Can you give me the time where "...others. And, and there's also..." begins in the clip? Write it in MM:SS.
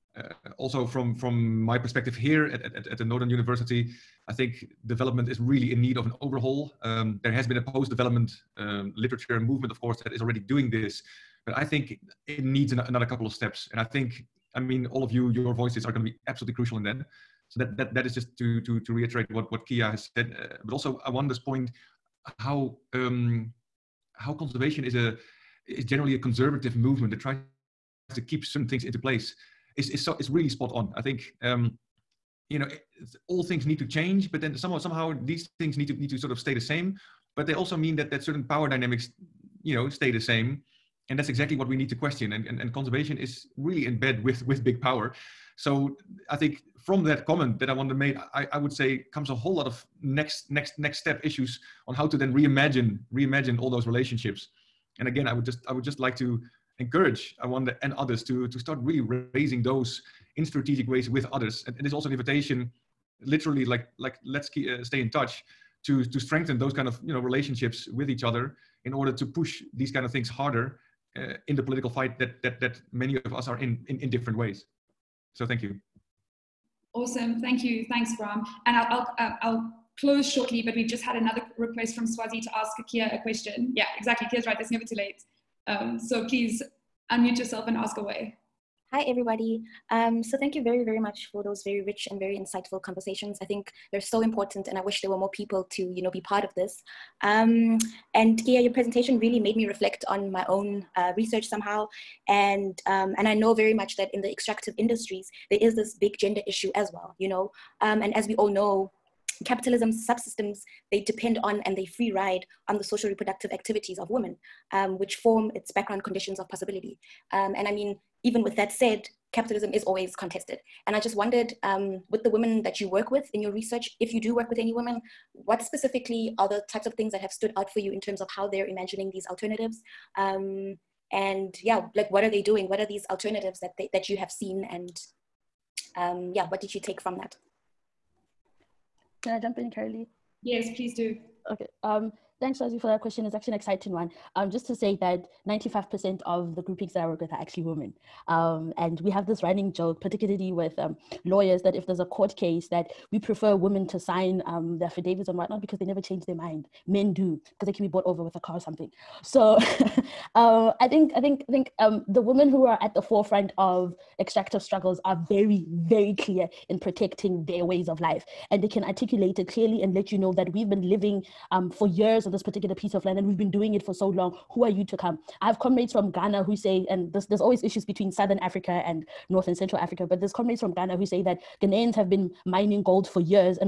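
01:01.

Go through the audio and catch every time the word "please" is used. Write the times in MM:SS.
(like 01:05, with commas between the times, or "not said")
01:26, 02:20.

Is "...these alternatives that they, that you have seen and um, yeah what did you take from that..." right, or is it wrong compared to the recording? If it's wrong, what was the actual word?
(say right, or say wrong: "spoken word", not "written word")
right.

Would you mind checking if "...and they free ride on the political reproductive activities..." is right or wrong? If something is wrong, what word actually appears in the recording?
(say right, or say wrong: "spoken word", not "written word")
wrong: "social", not "political".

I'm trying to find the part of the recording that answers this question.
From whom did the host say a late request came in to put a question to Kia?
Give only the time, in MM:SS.
01:22.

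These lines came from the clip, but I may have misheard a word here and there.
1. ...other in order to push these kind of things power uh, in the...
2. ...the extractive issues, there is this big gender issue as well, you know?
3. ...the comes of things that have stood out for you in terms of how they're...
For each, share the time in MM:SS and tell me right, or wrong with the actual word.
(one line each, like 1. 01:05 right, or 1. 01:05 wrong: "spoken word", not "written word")
1. 01:08 wrong: "harder", not "power"
2. 01:44 wrong: "industries", not "issues"
3. 02:06 wrong: "types", not "comes".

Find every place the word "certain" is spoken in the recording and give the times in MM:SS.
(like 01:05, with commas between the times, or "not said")
00:28, 00:38.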